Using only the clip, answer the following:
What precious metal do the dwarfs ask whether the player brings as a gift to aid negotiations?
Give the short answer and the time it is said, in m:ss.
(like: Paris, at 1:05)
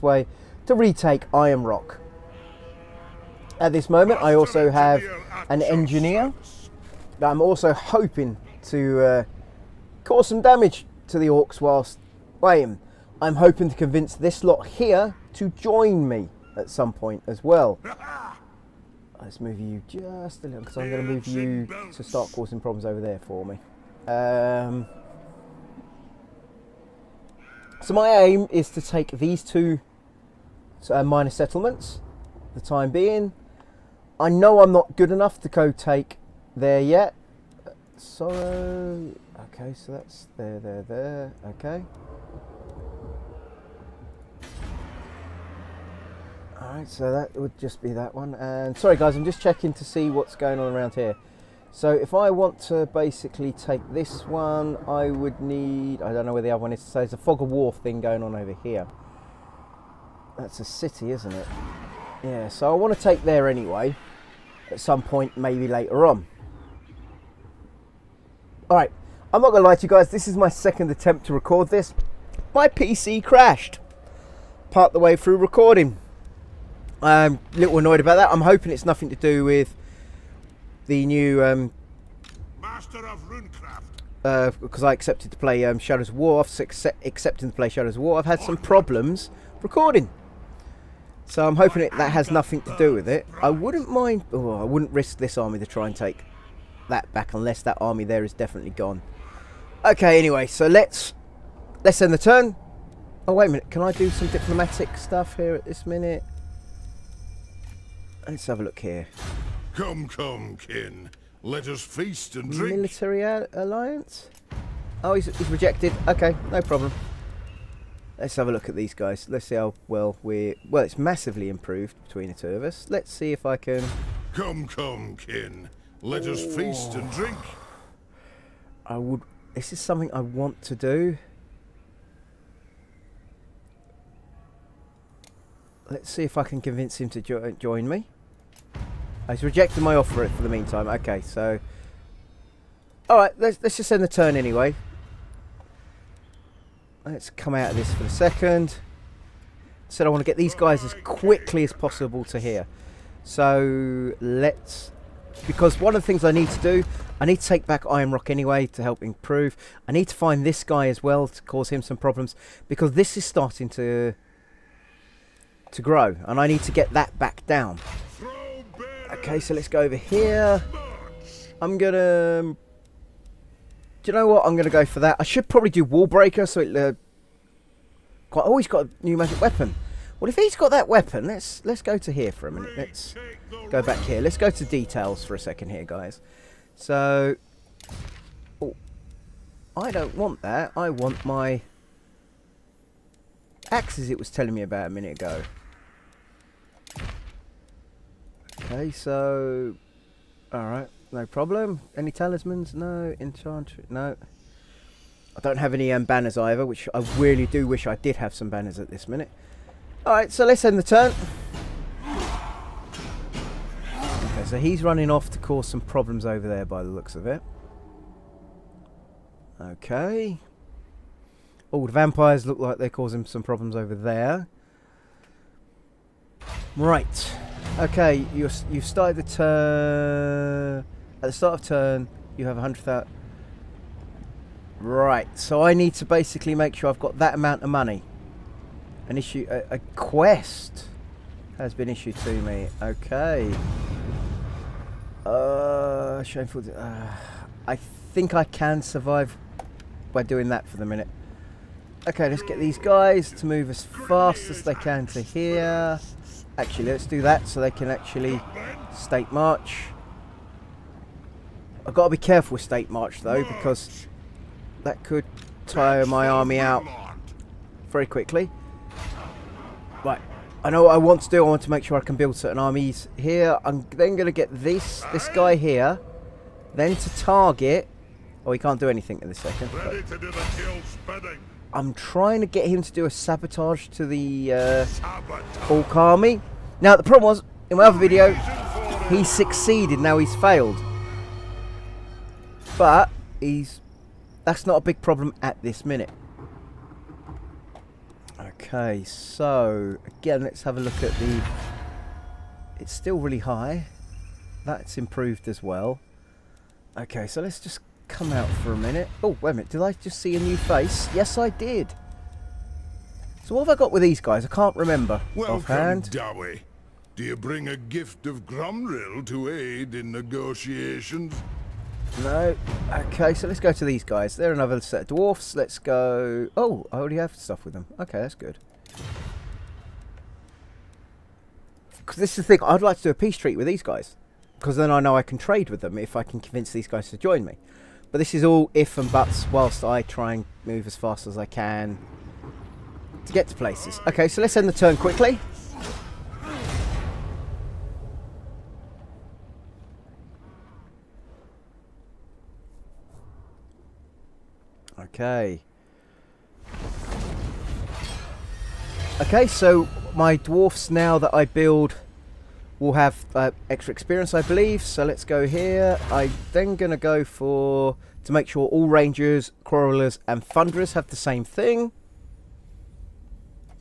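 Gromril, at 5:18.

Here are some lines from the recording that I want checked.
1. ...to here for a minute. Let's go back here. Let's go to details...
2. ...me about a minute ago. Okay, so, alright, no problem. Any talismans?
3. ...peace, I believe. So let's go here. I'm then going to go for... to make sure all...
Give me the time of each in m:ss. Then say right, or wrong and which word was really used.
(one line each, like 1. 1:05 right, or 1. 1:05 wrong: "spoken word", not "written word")
1. 3:01 right
2. 3:14 right
3. 6:03 wrong: "experience", not "peace".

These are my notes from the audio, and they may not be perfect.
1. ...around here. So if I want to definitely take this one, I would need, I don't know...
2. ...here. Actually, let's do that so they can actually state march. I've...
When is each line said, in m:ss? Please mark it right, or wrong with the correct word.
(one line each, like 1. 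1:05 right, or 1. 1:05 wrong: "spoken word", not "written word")
1. 0:50 wrong: "basically", not "definitely"
2. 4:15 right.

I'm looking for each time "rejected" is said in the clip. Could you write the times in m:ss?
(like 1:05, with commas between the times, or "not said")
1:55, 2:19.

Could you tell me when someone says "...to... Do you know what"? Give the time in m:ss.
2:51.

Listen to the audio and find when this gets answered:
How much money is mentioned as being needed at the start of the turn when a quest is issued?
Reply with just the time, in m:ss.
3:52.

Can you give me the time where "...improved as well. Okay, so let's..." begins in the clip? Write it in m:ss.
5:04.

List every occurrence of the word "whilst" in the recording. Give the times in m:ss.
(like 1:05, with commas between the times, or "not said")
0:11, 5:39.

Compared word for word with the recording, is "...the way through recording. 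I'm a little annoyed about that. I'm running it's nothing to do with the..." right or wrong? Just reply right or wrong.
wrong.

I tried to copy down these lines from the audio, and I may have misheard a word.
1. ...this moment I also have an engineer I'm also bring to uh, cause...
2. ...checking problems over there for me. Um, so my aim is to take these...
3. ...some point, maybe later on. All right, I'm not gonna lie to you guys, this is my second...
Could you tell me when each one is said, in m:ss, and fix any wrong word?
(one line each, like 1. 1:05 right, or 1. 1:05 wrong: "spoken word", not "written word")
1. 0:03 wrong: "hoping", not "bring"
2. 0:22 wrong: "causing", not "checking"
3. 1:04 right.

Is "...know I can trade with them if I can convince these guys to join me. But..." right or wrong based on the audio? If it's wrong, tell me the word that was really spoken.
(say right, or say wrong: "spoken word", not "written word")
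right.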